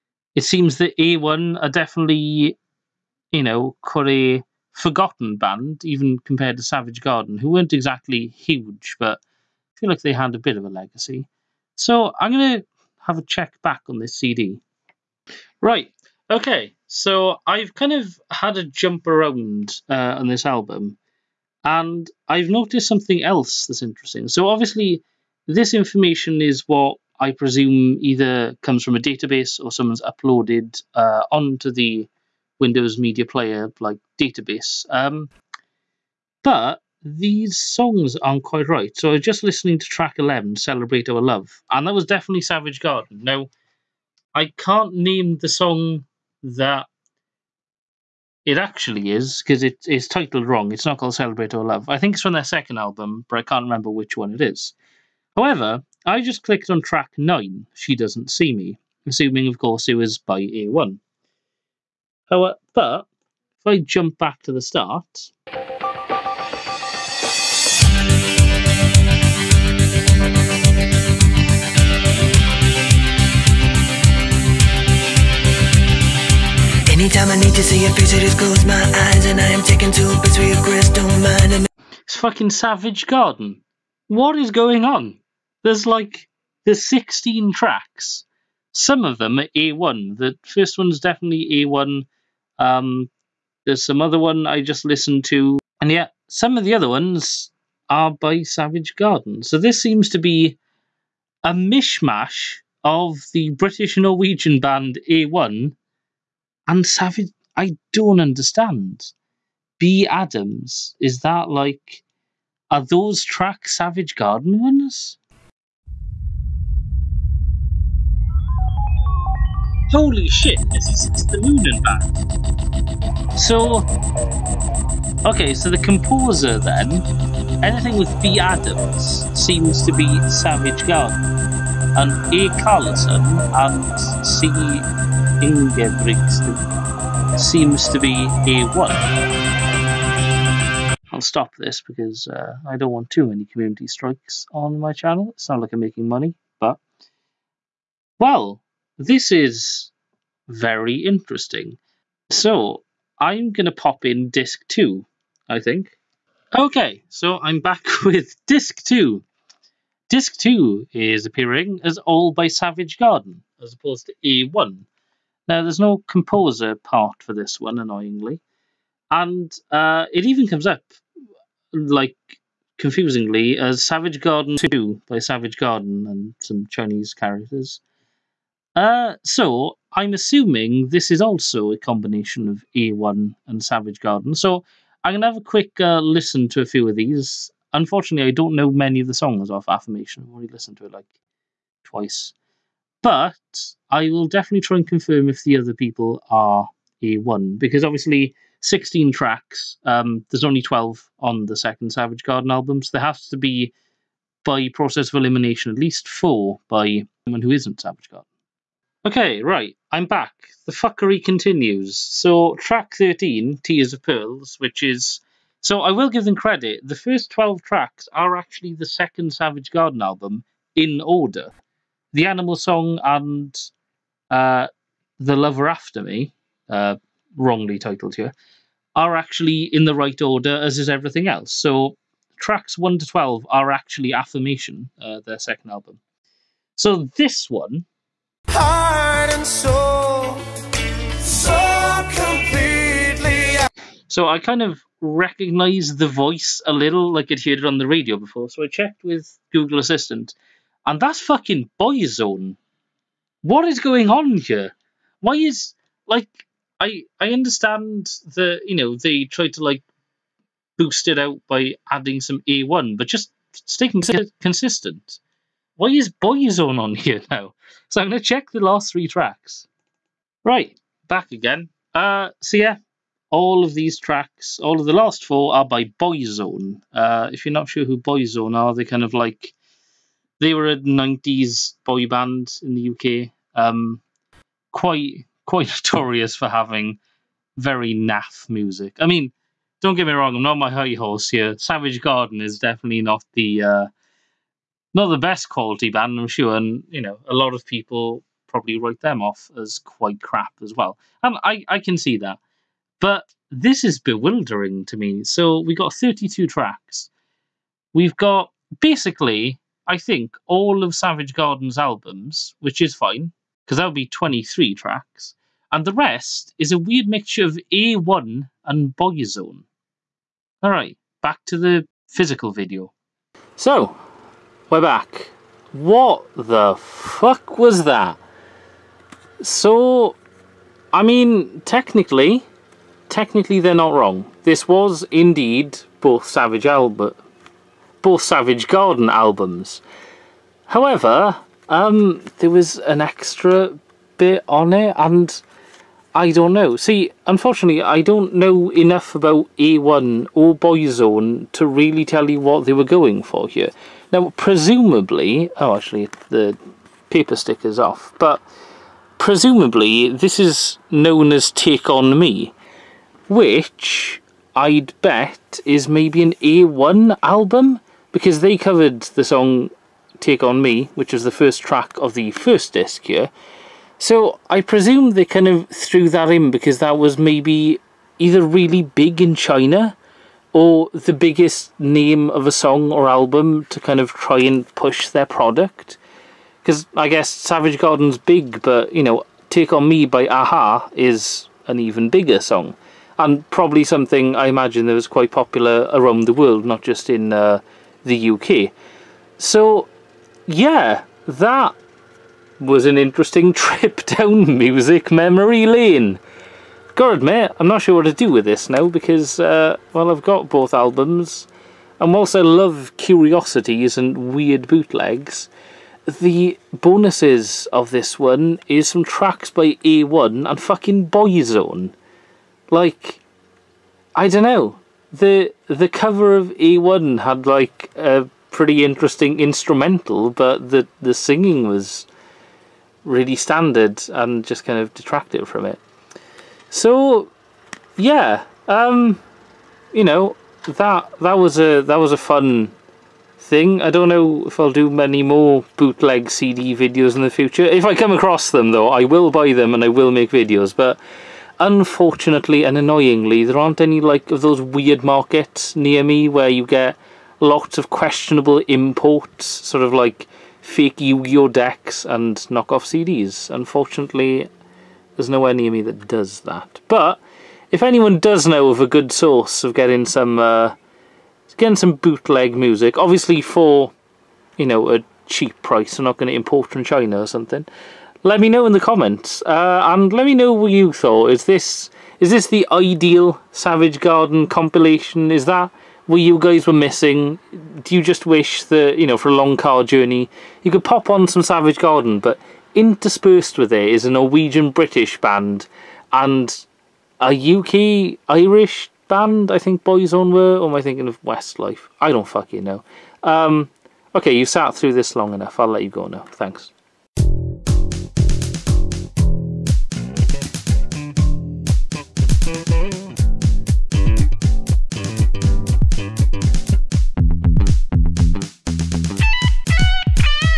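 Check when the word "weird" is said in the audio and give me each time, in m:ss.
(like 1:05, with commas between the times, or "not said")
5:16, 6:54, 7:34.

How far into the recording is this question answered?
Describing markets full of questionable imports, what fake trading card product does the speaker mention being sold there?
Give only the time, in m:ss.
7:40.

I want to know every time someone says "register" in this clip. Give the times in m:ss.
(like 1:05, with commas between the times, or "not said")
not said.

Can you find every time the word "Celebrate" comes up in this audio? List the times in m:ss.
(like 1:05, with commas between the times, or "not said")
0:40, 0:51.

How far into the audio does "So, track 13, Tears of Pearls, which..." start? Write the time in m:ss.
3:31.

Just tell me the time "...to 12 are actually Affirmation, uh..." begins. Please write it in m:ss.
3:52.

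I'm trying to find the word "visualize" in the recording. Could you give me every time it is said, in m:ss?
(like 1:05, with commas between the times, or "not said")
not said.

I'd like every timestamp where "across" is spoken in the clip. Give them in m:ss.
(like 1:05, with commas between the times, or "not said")
7:28.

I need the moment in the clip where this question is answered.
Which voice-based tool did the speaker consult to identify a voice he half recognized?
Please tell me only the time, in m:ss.
4:09.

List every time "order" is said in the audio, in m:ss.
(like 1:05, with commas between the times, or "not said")
3:40, 3:50.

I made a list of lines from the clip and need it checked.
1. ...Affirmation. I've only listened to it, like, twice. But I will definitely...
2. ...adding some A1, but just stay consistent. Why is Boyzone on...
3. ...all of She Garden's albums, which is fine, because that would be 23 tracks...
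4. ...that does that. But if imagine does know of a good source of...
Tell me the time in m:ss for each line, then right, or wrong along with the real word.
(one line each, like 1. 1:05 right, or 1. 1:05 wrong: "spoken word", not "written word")
1. 3:09 right
2. 4:21 right
3. 5:10 wrong: "Savage", not "She"
4. 7:45 wrong: "anyone", not "imagine".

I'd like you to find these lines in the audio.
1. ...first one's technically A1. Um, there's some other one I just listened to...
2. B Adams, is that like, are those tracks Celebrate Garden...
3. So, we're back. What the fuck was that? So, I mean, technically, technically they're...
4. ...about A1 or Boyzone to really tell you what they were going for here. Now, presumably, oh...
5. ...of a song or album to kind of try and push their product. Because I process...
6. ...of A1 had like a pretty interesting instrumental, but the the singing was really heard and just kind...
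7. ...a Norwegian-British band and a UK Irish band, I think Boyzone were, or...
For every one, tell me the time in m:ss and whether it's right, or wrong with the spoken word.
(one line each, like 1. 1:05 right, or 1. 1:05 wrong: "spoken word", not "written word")
1. 1:30 wrong: "definitely", not "technically"
2. 1:49 wrong: "Savage", not "Celebrate"
3. 5:23 right
4. 5:49 right
5. 6:22 wrong: "guess", not "process"
6. 7:06 wrong: "standard", not "heard"
7. 8:14 right.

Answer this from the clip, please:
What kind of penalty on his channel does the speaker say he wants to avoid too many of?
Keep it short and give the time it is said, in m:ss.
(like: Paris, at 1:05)
community strikes, at 2:23.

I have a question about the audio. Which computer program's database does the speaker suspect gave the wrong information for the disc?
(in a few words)
Windows Media Player.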